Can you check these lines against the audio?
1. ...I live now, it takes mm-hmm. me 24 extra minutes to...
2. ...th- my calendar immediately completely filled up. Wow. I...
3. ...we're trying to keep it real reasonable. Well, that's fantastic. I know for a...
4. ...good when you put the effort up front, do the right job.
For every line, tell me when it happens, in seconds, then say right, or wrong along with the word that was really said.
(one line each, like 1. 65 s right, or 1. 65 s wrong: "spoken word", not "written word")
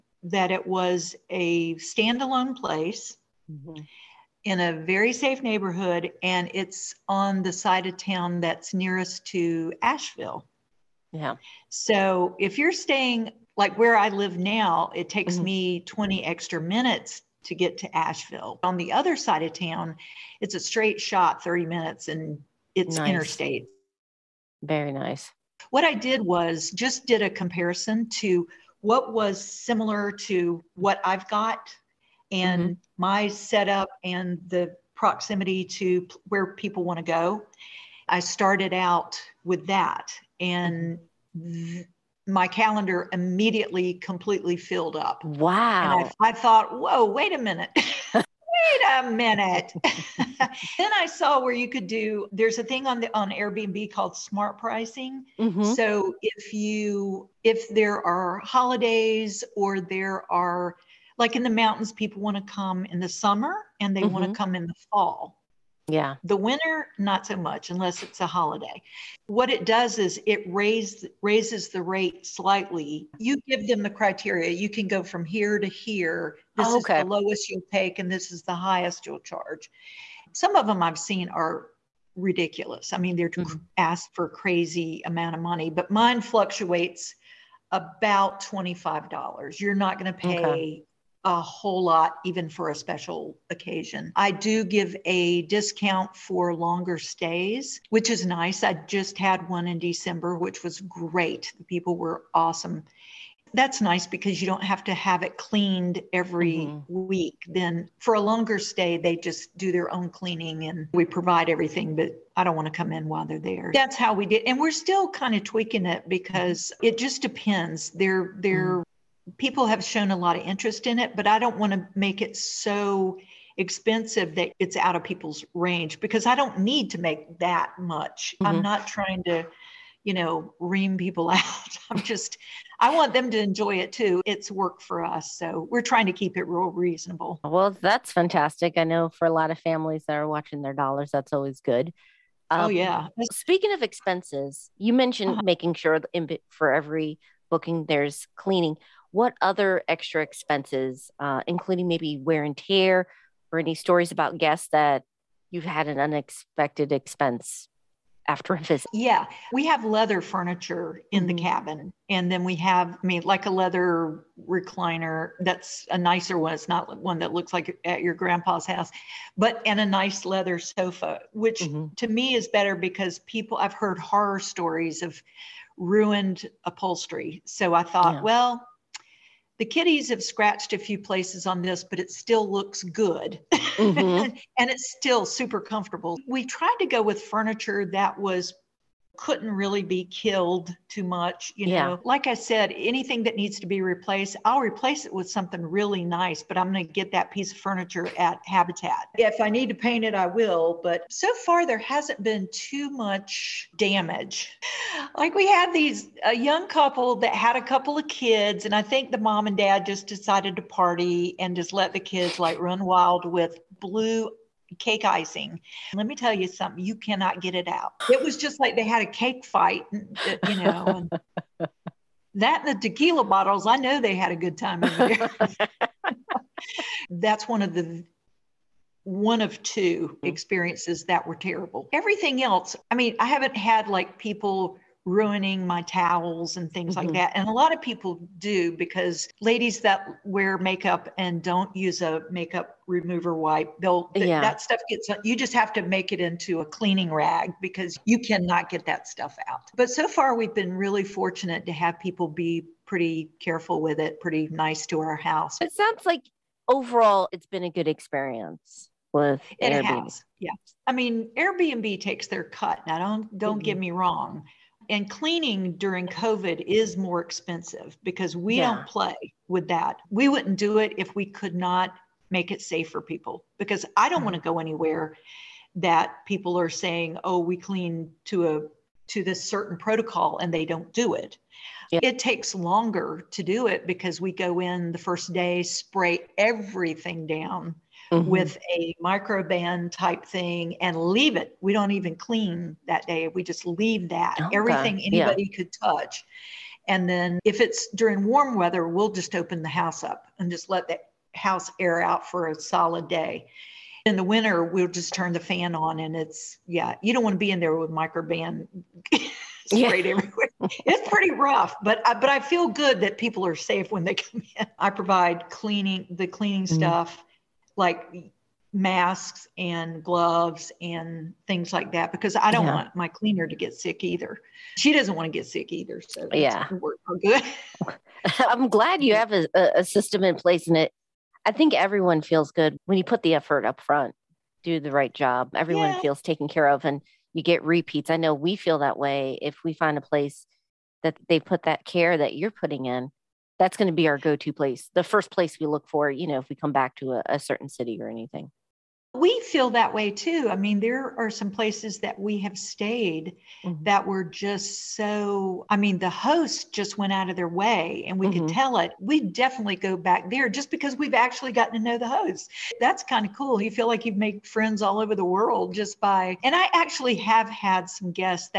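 1. 13 s wrong: "20", not "24"
2. 41 s right
3. 135 s right
4. 332 s right.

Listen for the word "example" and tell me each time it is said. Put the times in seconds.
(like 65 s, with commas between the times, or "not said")
not said.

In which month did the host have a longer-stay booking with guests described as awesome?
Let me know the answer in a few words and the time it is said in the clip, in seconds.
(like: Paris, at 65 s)
December, at 99 s.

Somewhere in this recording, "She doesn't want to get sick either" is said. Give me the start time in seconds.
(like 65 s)
324 s.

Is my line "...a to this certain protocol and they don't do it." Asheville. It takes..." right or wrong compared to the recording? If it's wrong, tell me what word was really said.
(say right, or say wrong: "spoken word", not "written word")
wrong: "Yeah", not "Asheville".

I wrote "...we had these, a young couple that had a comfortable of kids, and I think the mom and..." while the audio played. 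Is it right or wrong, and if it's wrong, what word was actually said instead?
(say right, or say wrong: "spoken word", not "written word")
wrong: "couple", not "comfortable".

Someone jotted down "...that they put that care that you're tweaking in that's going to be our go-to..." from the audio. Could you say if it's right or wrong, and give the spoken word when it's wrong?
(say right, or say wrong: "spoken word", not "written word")
wrong: "putting", not "tweaking".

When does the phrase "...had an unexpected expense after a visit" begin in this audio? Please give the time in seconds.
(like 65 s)
155 s.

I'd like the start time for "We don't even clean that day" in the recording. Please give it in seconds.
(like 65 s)
291 s.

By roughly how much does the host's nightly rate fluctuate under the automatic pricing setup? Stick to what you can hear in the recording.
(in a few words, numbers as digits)
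$25.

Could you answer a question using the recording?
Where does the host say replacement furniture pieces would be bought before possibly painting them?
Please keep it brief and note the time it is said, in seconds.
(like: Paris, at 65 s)
Habitat, at 198 s.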